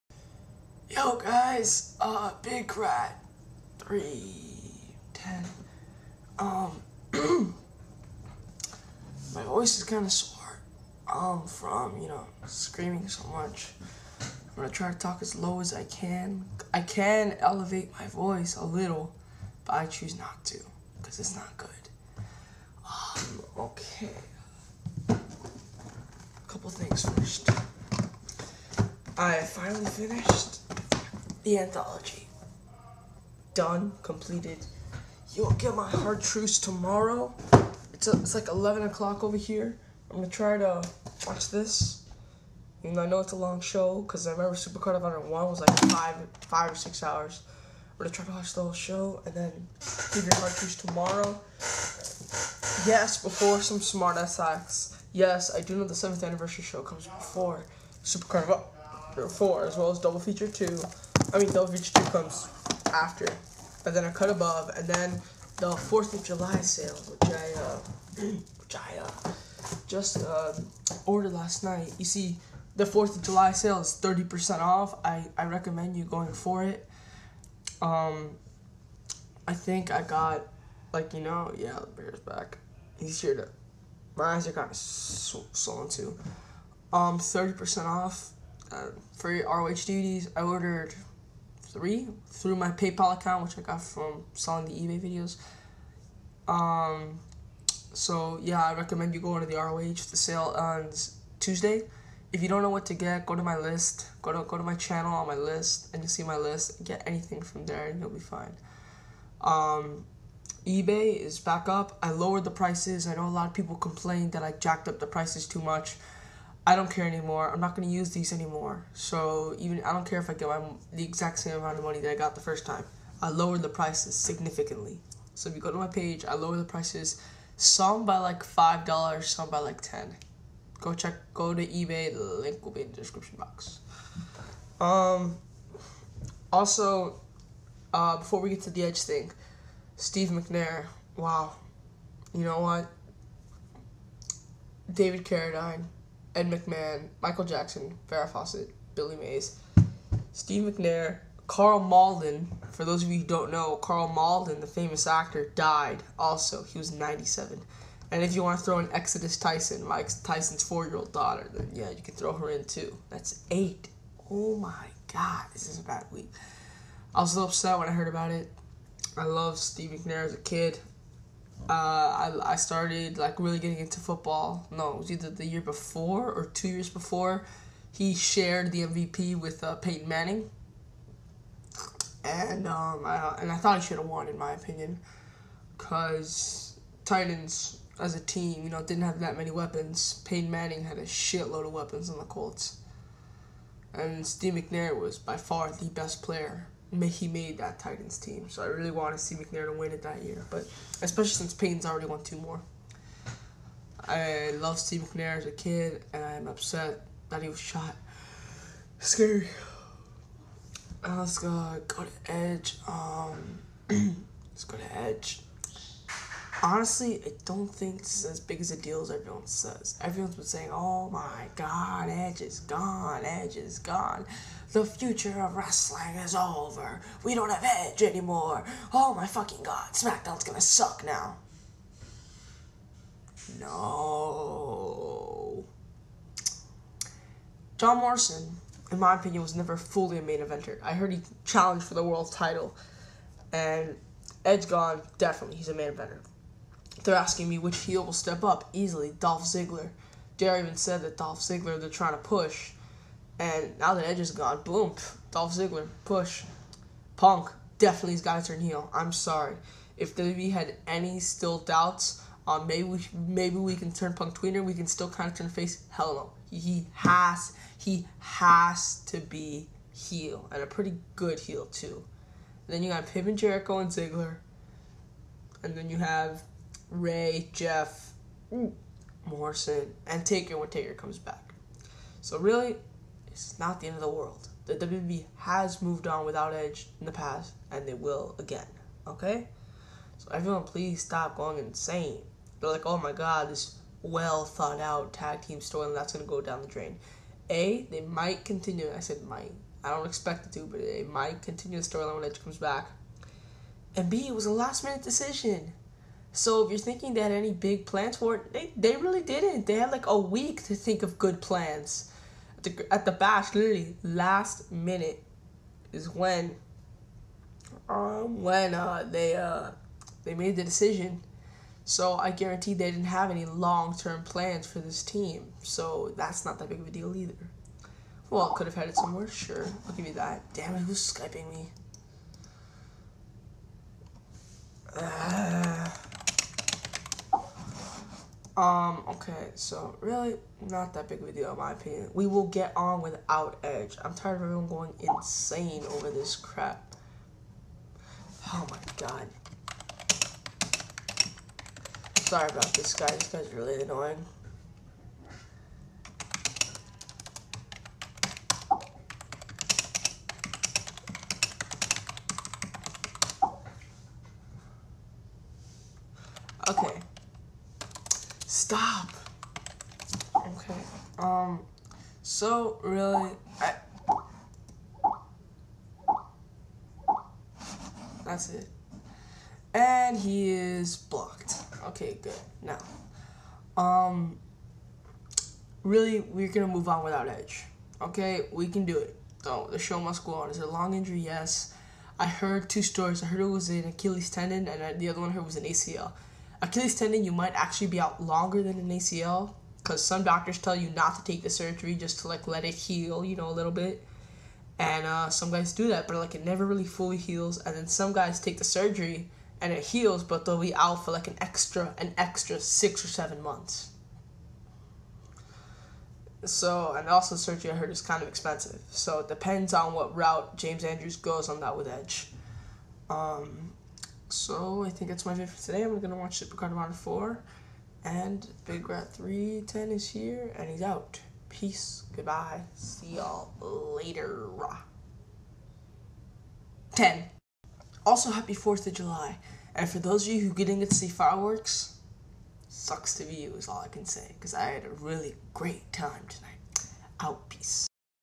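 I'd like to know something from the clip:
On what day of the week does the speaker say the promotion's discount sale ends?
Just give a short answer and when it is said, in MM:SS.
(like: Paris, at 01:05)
Tuesday, at 01:41.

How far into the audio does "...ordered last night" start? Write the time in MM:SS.
01:11.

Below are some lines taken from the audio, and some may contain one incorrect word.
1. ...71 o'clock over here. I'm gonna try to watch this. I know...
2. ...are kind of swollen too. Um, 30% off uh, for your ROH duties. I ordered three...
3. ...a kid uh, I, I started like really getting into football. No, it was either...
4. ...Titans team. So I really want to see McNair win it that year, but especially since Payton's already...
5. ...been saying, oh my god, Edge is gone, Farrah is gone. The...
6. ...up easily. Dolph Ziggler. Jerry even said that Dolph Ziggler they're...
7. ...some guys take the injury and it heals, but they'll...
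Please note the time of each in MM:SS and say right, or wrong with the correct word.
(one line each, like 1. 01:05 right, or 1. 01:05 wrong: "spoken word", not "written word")
1. 00:38 wrong: "11", not "71"
2. 01:24 right
3. 02:50 right
4. 03:17 right
5. 03:40 wrong: "Edge", not "Farrah"
6. 04:08 right
7. 06:47 wrong: "surgery", not "injury".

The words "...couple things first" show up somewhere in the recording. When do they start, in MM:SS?
00:26.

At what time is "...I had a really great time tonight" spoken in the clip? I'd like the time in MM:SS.
07:24.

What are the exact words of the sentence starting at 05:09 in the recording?
They had like a week to think of good plans.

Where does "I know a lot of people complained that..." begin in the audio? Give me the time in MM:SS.
01:53.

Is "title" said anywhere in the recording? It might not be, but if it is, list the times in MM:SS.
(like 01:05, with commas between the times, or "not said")
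04:02.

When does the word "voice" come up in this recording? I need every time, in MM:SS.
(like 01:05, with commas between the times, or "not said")
00:09, 00:18.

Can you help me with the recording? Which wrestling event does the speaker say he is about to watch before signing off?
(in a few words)
Supercard of Honor 4.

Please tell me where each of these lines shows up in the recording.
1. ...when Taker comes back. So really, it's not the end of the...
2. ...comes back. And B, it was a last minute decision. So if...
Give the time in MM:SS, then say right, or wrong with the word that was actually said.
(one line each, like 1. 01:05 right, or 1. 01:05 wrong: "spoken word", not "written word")
1. 04:40 right
2. 05:02 right.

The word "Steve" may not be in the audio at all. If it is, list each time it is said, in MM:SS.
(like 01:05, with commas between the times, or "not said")
02:19, 02:30, 02:49, 03:14, 03:24.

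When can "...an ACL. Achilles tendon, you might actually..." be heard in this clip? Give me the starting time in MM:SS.
06:35.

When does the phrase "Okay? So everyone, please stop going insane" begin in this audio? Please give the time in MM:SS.
04:49.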